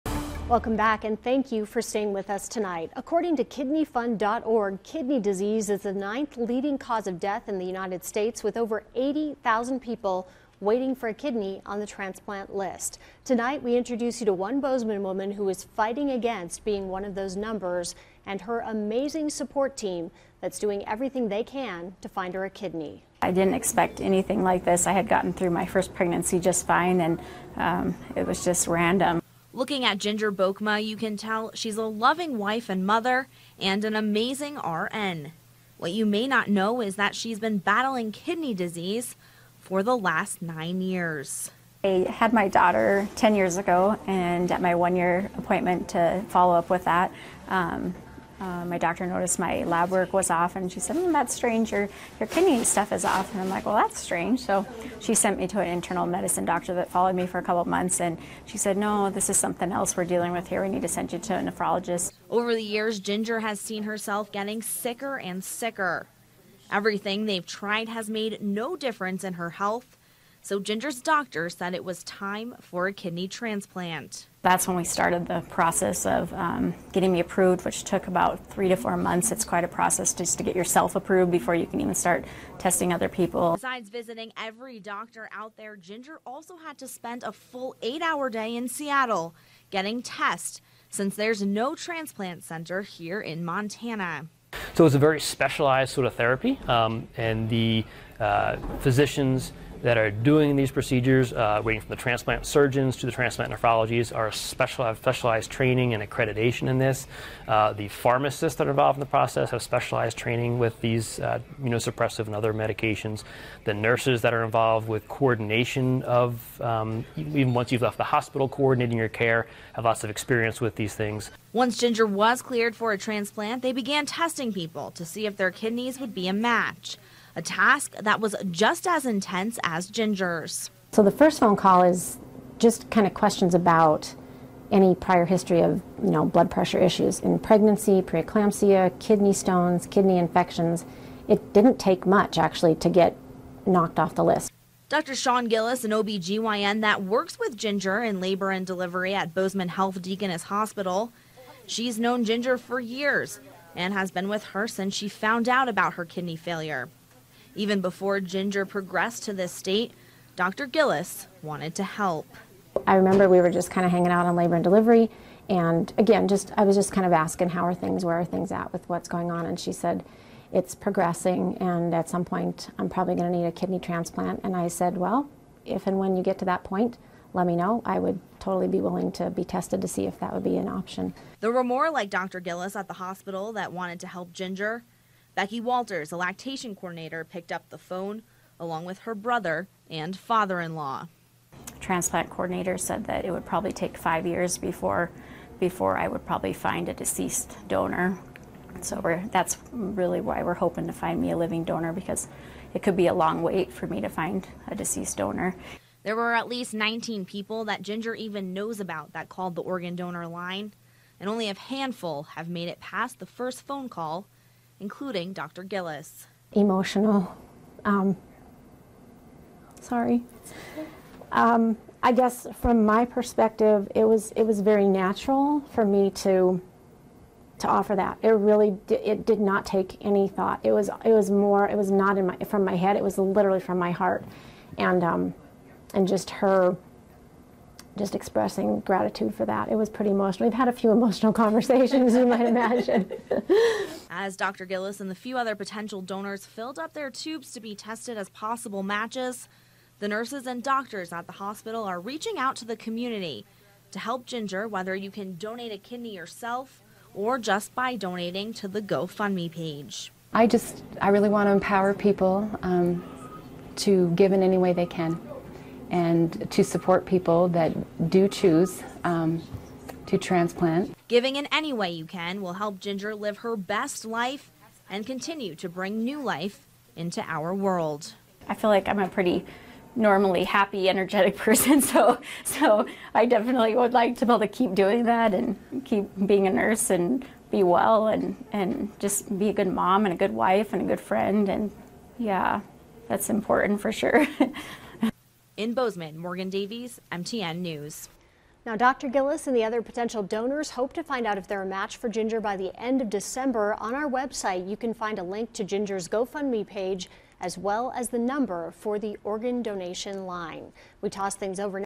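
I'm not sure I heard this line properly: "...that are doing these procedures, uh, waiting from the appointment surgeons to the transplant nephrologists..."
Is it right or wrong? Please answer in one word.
wrong.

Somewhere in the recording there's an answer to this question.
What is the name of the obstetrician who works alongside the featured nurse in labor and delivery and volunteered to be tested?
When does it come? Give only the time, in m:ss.
2:25.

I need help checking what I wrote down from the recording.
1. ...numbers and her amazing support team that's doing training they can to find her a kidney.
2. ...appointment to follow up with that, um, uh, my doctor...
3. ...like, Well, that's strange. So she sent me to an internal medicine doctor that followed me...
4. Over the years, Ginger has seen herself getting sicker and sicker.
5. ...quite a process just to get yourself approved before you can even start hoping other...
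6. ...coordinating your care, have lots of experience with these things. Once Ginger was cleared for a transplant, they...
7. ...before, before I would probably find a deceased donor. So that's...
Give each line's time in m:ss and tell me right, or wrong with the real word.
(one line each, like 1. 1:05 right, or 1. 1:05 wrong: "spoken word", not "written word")
1. 0:17 wrong: "everything", not "training"
2. 0:45 right
3. 0:53 right
4. 1:02 right
5. 1:19 wrong: "testing", not "hoping"
6. 1:58 right
7. 3:14 right.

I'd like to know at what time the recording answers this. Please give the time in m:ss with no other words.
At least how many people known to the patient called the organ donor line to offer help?
3:26.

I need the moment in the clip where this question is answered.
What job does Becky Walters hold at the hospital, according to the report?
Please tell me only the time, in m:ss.
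3:06.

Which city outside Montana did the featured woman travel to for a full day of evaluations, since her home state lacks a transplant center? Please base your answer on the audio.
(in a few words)
Seattle.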